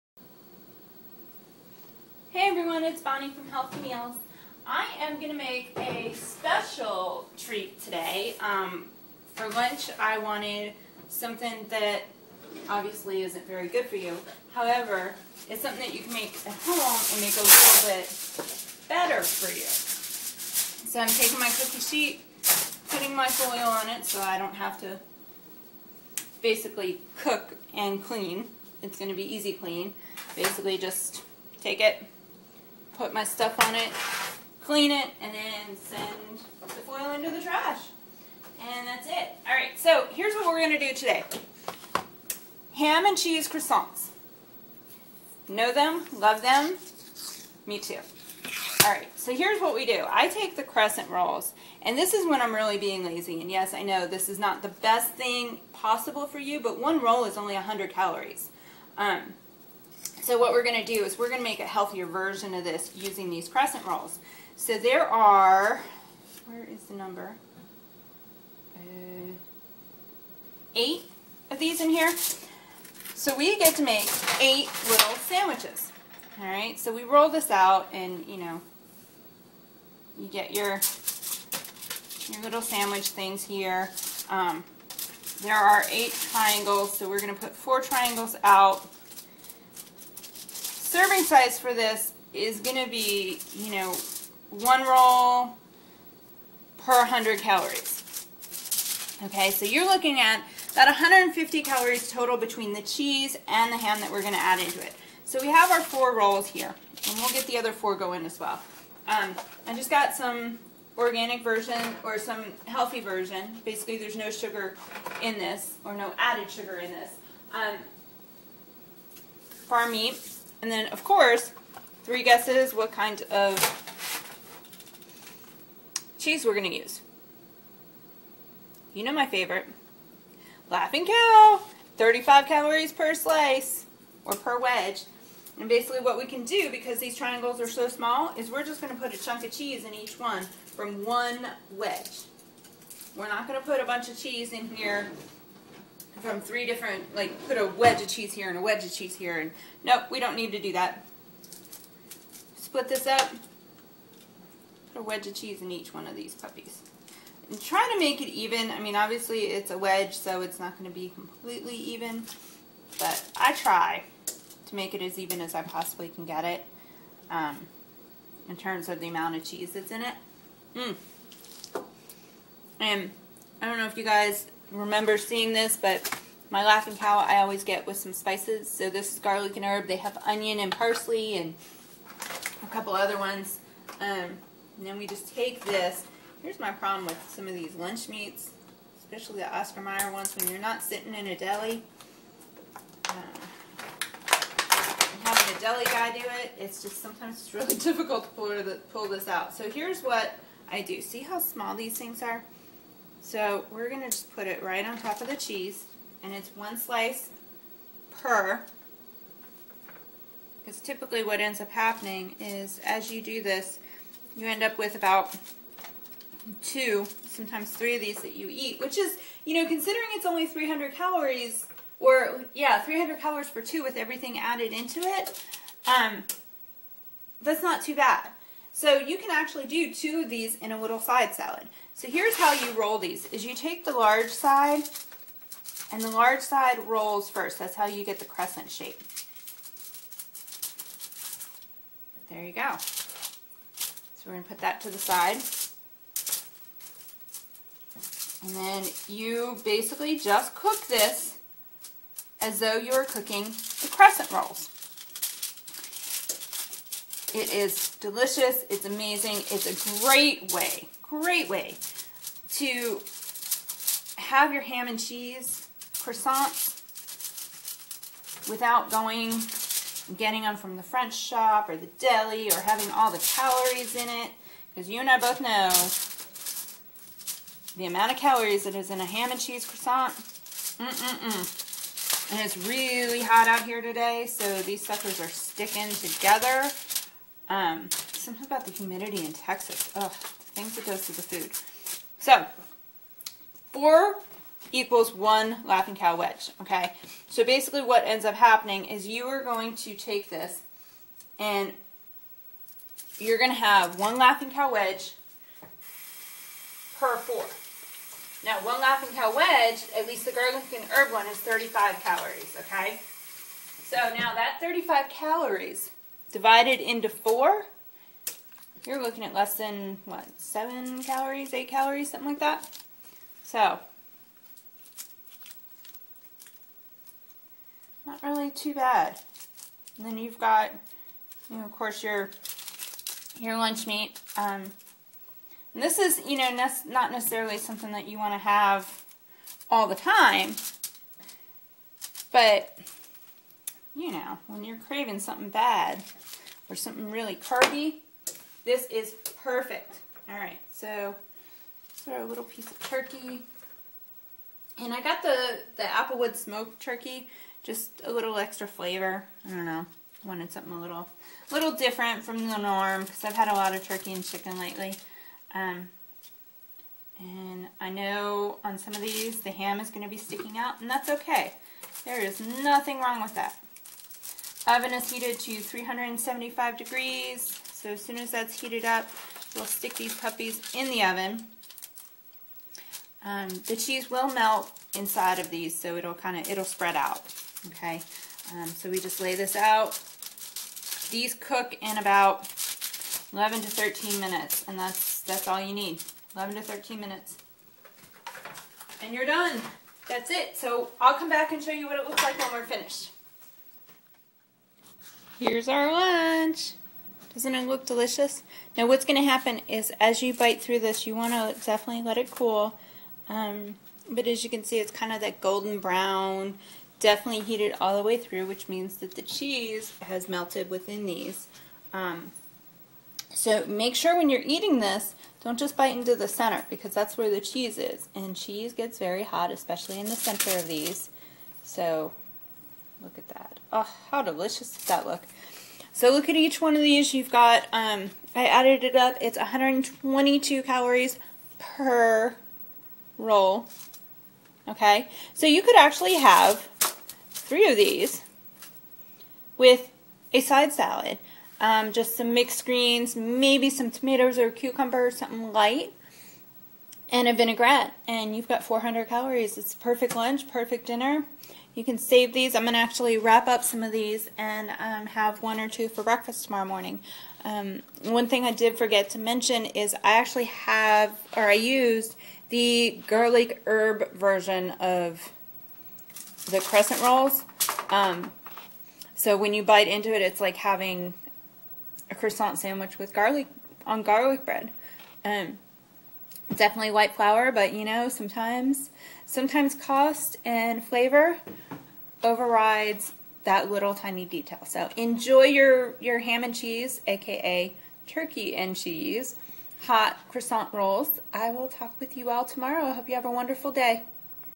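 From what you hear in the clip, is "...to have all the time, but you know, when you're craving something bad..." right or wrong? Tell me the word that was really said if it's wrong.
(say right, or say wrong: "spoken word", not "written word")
right.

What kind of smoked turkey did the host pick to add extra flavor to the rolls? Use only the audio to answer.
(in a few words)
Applewood smoked.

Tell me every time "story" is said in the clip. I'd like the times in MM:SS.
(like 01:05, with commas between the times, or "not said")
not said.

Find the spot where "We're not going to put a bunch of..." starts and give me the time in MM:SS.
02:23.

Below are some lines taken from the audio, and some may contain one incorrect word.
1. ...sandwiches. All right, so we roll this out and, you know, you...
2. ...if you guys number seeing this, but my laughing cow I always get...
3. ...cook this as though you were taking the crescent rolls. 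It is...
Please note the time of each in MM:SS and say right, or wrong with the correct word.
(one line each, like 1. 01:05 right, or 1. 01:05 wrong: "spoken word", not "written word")
1. 01:15 right
2. 02:53 wrong: "remember", not "number"
3. 04:10 wrong: "cooking", not "taking".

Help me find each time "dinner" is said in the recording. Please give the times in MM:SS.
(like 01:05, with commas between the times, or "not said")
07:40.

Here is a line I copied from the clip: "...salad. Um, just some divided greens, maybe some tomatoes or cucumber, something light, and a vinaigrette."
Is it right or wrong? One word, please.
wrong.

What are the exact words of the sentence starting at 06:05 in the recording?
Um, and I know on some of these the ham is going to be sticking out, and that's okay.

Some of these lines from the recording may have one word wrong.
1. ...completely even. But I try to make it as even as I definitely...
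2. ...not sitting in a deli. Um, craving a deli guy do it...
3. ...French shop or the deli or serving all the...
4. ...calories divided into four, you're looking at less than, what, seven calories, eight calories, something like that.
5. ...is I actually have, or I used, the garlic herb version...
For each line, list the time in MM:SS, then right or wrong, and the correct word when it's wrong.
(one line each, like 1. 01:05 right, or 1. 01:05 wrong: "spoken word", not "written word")
1. 02:41 wrong: "possibly", not "definitely"
2. 03:10 wrong: "having", not "craving"
3. 04:30 wrong: "having", not "serving"
4. 05:15 right
5. 07:49 right.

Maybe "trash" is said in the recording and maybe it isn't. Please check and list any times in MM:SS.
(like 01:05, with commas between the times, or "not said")
00:37.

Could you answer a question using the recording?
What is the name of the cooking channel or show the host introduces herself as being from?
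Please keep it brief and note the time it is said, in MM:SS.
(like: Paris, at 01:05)
Healthy Meals, at 00:03.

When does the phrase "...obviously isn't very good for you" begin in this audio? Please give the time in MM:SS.
00:12.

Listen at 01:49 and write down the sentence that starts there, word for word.
Um, I just got some organic version or some healthy version.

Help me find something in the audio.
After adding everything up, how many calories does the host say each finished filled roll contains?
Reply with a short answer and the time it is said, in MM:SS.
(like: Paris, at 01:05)
122, at 07:19.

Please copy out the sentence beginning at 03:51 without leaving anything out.
So here's how you roll these, is you take the large side, and the large side rolls first.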